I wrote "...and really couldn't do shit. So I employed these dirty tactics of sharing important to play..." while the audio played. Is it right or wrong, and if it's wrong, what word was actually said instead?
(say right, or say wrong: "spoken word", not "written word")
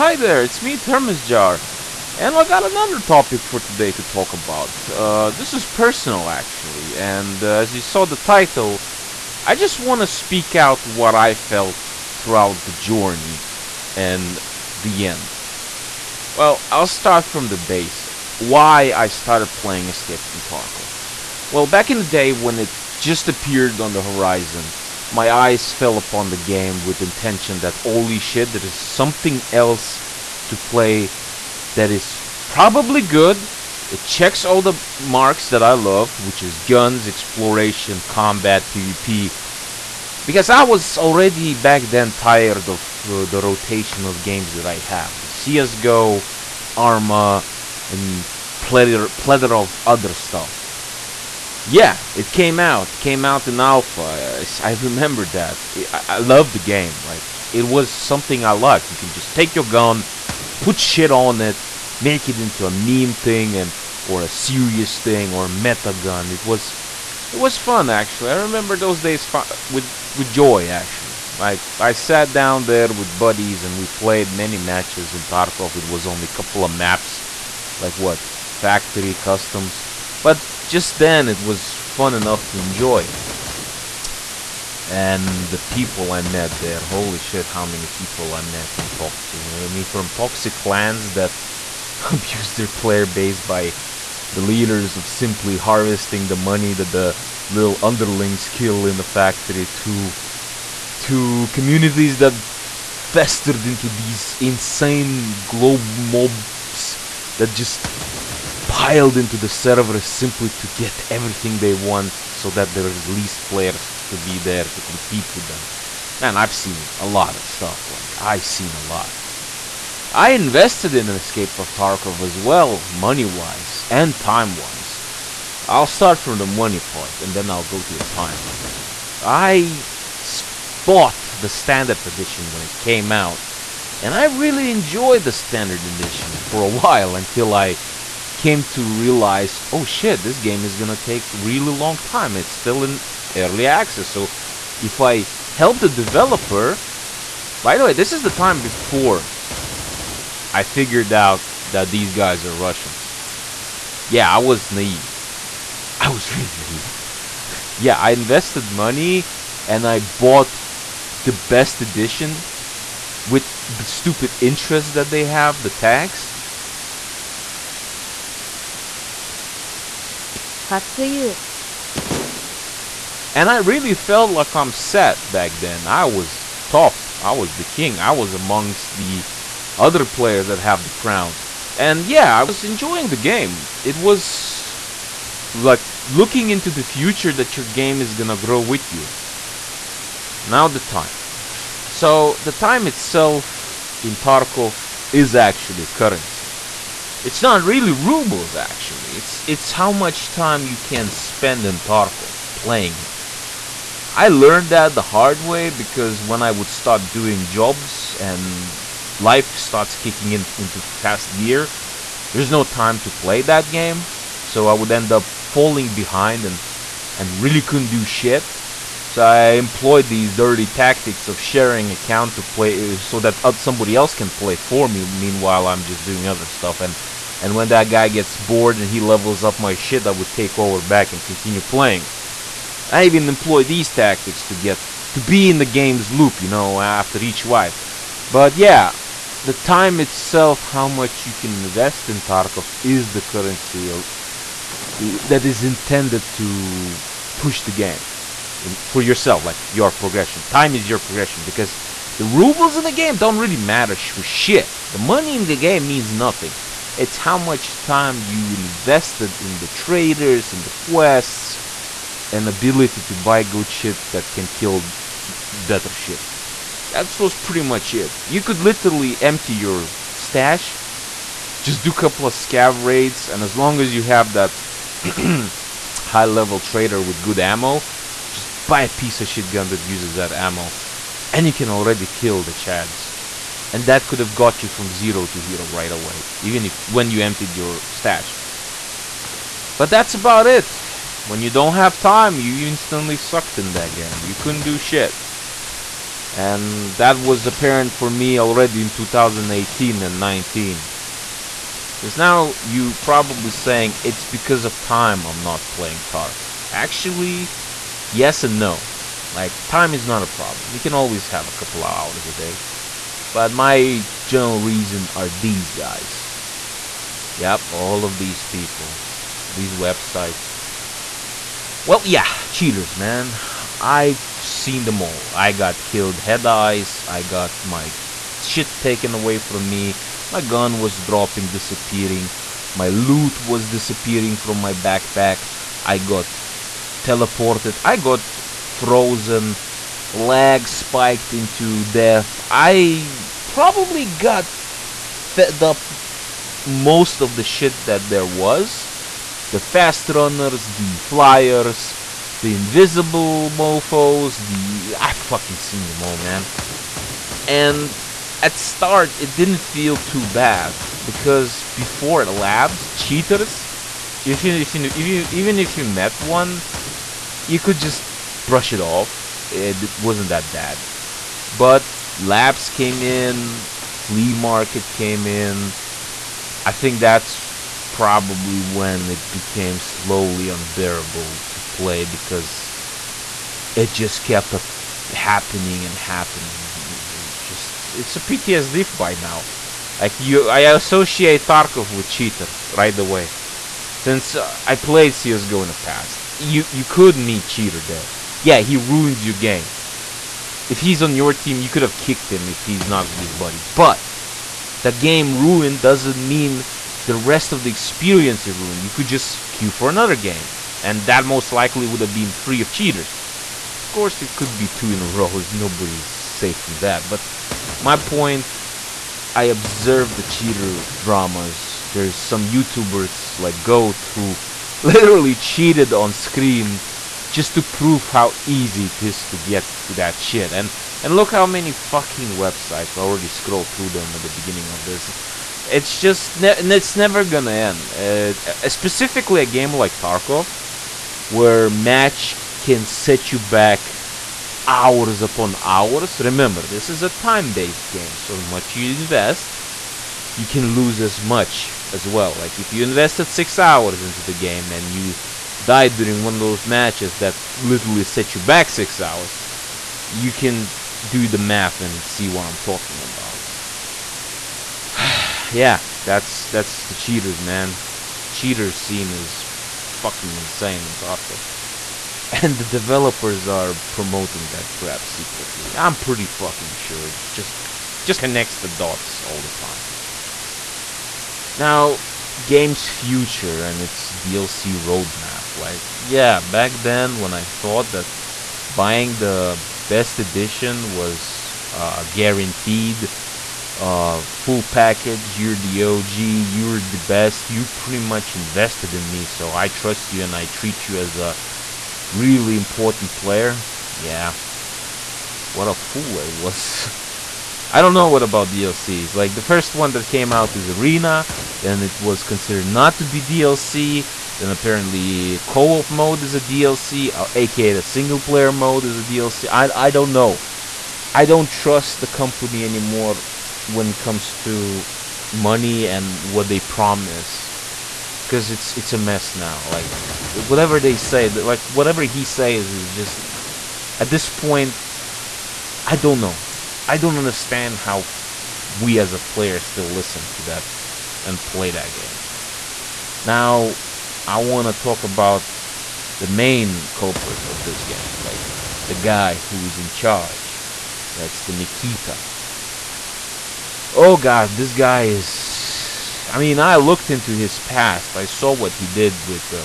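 wrong: "account", not "important".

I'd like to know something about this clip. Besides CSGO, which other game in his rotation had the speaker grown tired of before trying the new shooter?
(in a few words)
Arma.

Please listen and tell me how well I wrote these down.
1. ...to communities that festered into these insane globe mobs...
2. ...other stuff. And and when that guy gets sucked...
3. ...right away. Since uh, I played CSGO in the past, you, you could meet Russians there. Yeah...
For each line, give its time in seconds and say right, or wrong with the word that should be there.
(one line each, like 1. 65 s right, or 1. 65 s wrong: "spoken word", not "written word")
1. 100 s right
2. 226 s wrong: "bored", not "sucked"
3. 392 s wrong: "Cheater", not "Russians".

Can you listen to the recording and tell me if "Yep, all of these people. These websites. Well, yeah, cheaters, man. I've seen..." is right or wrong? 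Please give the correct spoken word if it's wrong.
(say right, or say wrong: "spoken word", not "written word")
right.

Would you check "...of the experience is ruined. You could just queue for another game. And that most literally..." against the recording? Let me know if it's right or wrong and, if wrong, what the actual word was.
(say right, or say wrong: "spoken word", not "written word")
wrong: "likely", not "literally".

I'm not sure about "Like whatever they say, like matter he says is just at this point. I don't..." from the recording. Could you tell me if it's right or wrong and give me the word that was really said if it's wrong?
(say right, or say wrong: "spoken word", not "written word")
wrong: "whatever", not "matter".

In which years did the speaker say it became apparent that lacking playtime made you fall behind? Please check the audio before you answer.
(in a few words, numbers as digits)
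2018 and 2019.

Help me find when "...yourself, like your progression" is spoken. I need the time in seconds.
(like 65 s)
249 s.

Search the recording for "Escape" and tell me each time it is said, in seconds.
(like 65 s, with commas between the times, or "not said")
19 s, 121 s.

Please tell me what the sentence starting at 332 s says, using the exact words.
My loot was disappearing from my backpack.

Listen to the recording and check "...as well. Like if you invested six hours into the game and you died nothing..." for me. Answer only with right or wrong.
wrong.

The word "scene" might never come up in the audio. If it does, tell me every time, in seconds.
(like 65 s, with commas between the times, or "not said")
468 s.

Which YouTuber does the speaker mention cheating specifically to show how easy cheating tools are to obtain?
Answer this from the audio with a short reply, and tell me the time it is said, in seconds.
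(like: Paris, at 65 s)
Goat, at 423 s.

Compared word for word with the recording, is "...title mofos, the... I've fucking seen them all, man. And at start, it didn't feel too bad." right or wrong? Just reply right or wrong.
wrong.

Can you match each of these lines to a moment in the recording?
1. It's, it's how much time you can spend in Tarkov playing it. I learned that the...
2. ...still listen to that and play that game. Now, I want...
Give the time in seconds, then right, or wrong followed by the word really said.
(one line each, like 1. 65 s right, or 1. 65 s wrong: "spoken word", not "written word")
1. 199 s right
2. 539 s right.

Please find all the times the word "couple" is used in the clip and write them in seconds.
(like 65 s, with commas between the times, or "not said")
76 s, 271 s, 311 s.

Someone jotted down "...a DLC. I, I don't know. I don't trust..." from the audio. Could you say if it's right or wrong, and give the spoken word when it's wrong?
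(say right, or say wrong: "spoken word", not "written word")
right.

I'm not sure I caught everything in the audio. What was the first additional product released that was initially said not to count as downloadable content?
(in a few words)
Arena.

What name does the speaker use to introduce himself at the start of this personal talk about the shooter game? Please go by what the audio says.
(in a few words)
Termus Jar.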